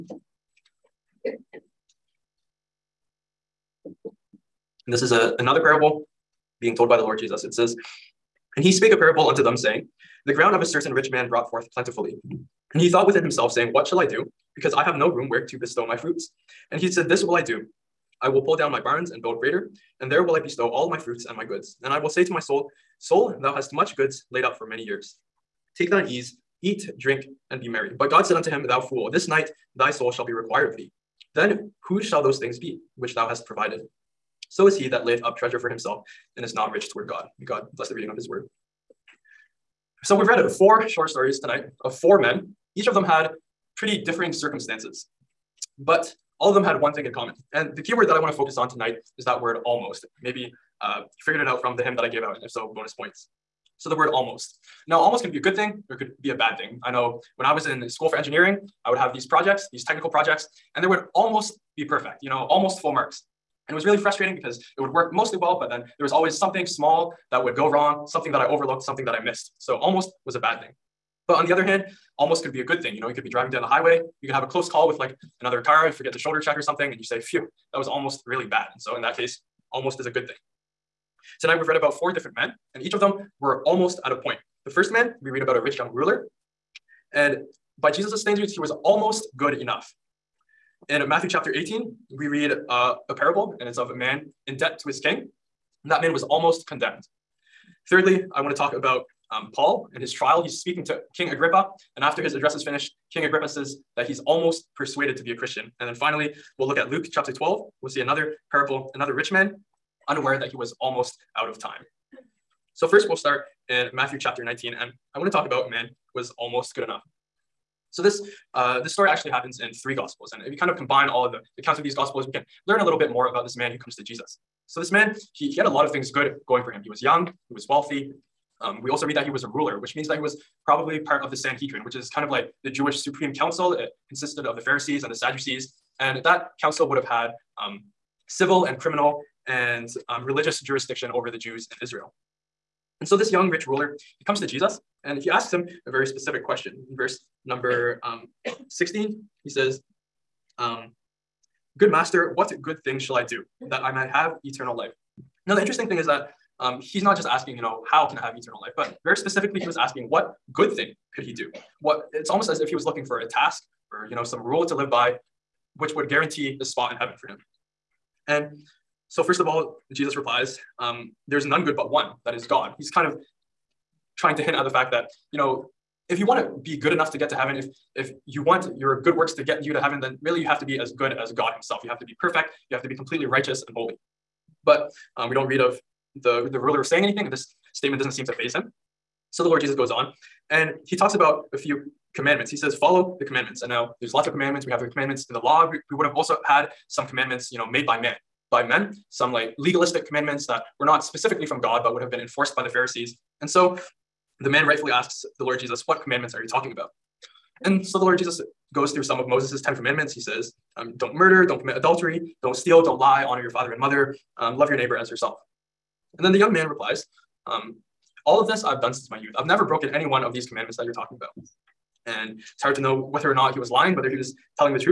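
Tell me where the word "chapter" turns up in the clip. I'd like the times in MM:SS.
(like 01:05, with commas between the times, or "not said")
01:31, 01:47, 01:54.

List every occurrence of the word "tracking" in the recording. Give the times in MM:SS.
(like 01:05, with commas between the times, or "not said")
not said.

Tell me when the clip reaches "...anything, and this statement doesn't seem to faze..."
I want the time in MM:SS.
03:07.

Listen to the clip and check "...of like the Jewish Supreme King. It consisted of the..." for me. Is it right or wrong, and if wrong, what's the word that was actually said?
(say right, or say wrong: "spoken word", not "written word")
wrong: "Council", not "King".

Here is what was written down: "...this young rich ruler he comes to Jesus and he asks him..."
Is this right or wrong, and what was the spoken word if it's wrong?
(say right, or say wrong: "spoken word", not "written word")
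right.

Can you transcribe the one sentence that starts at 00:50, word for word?
Maybe uh, you figured it out from the hymn that I gave out, and if so, bonus points.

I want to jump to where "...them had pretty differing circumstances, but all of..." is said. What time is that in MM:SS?
00:42.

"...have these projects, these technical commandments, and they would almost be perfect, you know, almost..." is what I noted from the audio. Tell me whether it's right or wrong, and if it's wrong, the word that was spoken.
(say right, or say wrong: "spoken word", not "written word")
wrong: "projects", not "commandments".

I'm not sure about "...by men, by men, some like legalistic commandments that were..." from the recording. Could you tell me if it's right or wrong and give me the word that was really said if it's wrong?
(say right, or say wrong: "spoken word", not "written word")
right.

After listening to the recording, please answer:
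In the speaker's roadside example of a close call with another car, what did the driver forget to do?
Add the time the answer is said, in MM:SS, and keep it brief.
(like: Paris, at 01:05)
Shoulder check, at 01:16.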